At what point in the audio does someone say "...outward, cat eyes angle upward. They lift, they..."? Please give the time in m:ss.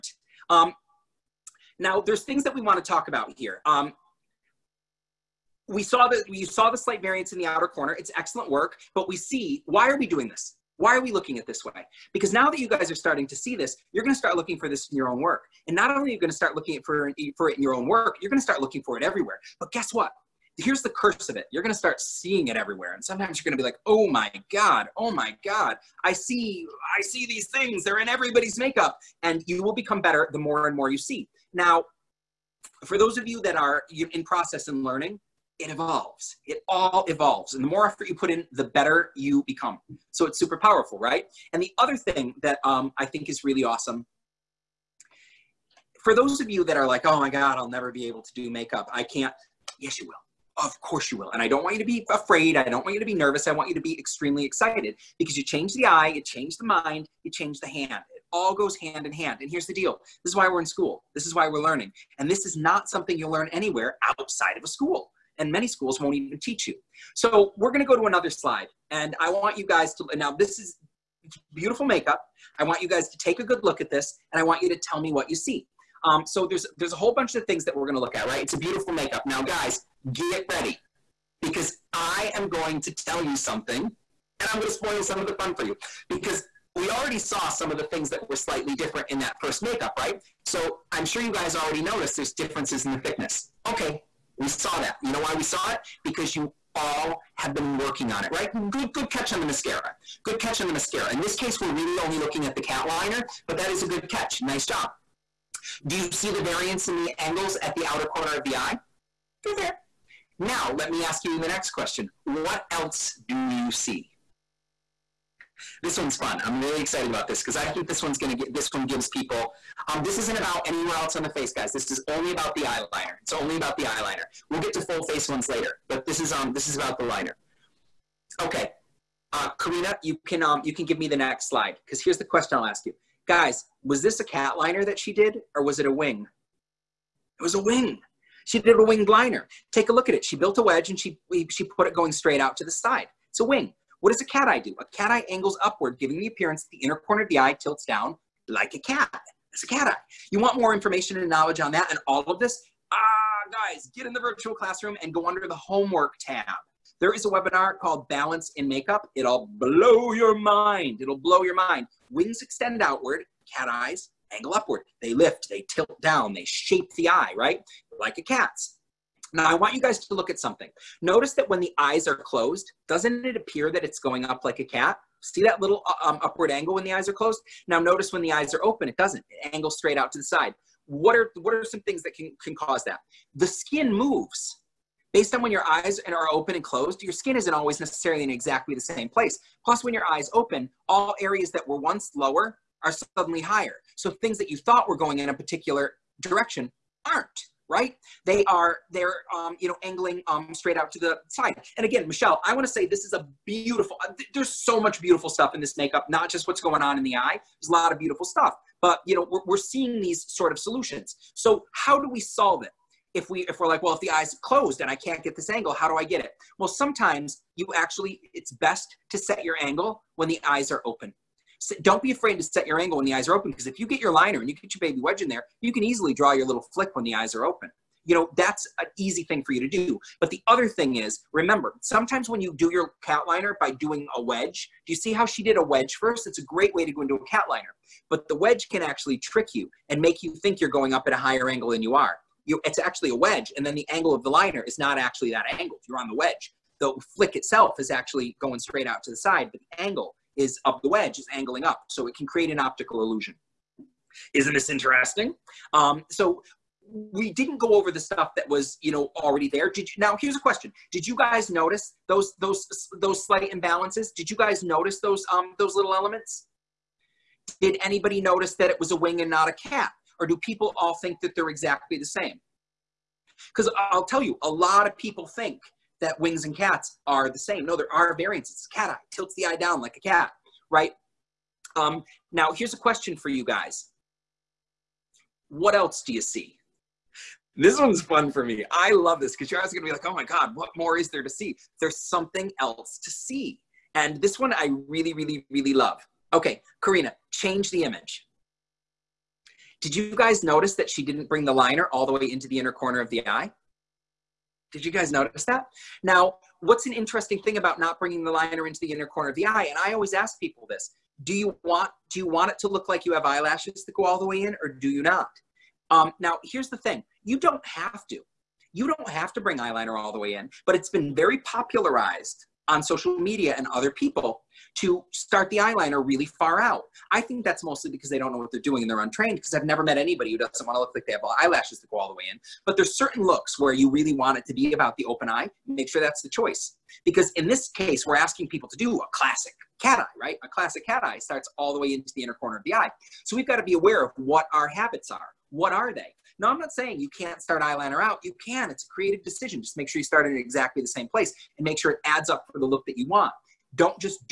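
2:42.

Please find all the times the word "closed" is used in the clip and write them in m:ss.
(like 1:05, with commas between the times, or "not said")
2:52, 2:57, 3:06, 3:34.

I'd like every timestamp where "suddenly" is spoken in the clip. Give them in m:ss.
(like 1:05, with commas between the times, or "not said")
3:13.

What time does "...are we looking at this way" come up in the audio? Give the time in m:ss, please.
0:10.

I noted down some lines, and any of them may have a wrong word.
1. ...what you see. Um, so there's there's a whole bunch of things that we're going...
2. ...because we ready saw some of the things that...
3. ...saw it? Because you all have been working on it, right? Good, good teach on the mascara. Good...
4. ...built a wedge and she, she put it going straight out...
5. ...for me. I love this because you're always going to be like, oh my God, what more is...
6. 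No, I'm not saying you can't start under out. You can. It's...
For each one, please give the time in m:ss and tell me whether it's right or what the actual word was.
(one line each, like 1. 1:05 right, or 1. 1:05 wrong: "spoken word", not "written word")
1. 1:15 right
2. 1:26 wrong: "already", not "ready"
3. 1:35 wrong: "catch", not "teach"
4. 2:20 right
5. 4:48 right
6. 5:46 wrong: "eyeliner", not "under".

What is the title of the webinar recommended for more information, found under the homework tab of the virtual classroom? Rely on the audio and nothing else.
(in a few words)
Balance in Makeup.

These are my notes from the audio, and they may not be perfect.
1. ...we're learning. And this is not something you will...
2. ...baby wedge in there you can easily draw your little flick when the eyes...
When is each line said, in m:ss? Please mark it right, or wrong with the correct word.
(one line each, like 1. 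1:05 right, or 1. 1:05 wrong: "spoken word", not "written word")
1. 1:01 right
2. 3:44 right.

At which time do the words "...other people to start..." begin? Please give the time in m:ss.
5:23.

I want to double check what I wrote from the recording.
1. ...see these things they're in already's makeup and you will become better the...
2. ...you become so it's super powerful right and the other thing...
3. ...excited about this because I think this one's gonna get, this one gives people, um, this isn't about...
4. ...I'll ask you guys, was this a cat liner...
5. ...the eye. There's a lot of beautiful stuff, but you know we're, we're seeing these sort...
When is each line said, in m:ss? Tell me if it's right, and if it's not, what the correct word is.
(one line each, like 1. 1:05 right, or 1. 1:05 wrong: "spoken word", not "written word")
1. 0:27 wrong: "everybody", not "already"
2. 0:39 right
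3. 1:56 right
4. 2:12 right
5. 3:27 right.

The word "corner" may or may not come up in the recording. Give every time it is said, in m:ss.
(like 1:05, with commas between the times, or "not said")
0:07, 1:48, 2:26, 5:02, 5:09, 5:42.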